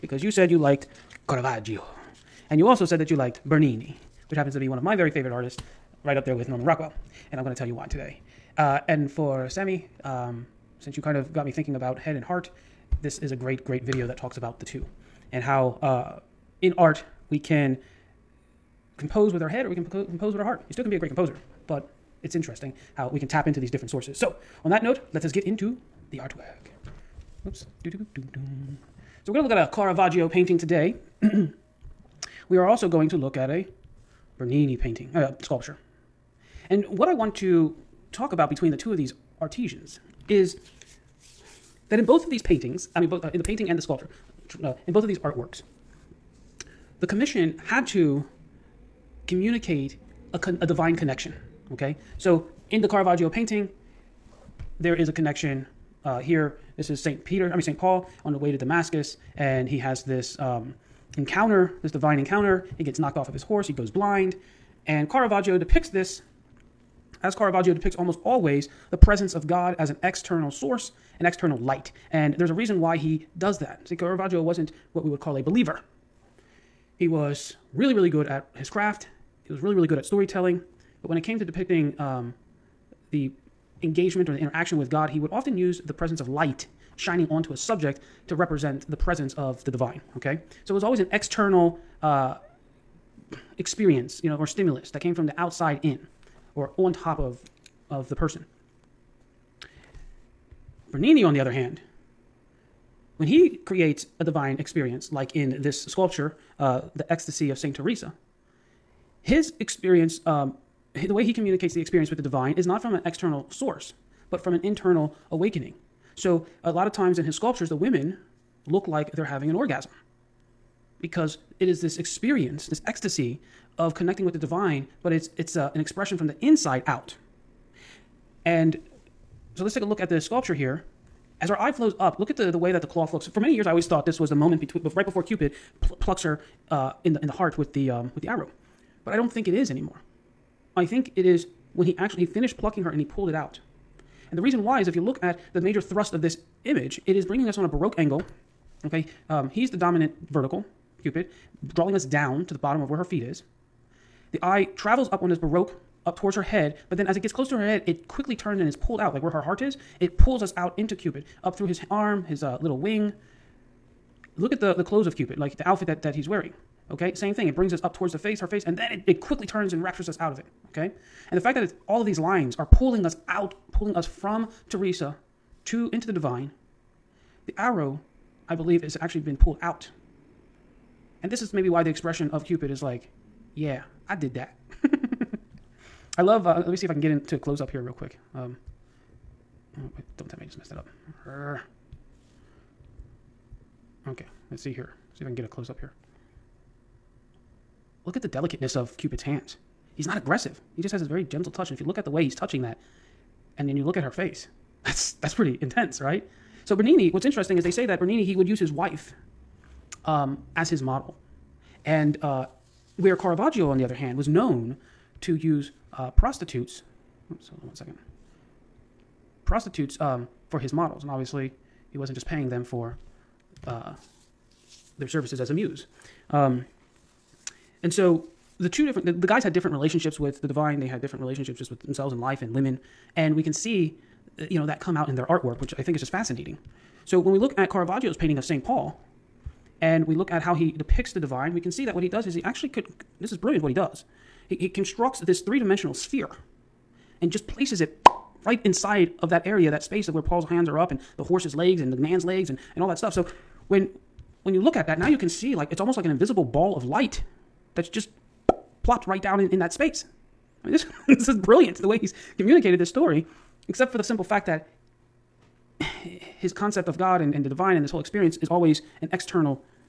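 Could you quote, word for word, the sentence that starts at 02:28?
Okay, um, he's the dominant vertical, Cupid, drawing us down to the bottom of where her feet is.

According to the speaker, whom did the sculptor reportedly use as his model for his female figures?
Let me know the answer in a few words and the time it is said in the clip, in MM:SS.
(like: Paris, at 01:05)
his wife, at 03:28.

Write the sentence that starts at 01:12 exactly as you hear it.
And there's a reason why he does that.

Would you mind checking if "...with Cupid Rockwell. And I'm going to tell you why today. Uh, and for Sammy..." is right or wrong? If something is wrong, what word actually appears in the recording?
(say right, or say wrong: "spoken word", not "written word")
wrong: "Norman", not "Cupid".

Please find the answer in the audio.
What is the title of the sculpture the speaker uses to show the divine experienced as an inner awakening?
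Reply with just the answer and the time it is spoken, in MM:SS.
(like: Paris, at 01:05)
Ecstasy of St. Teresa, at 01:47.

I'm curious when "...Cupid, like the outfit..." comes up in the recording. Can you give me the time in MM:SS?
02:45.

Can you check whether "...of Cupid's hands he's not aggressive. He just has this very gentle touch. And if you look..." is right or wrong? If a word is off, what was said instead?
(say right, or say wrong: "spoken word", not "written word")
right.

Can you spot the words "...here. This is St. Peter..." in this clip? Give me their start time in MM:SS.
00:56.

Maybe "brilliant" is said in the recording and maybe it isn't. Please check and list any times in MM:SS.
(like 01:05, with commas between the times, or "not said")
04:03, 04:21.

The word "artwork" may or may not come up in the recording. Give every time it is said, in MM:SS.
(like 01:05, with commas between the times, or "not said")
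00:26, 00:45, 03:55.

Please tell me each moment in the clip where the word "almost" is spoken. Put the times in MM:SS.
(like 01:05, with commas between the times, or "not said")
01:07, 04:15.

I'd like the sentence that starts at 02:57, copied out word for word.
The arrow, I believe, is actually been pulled out.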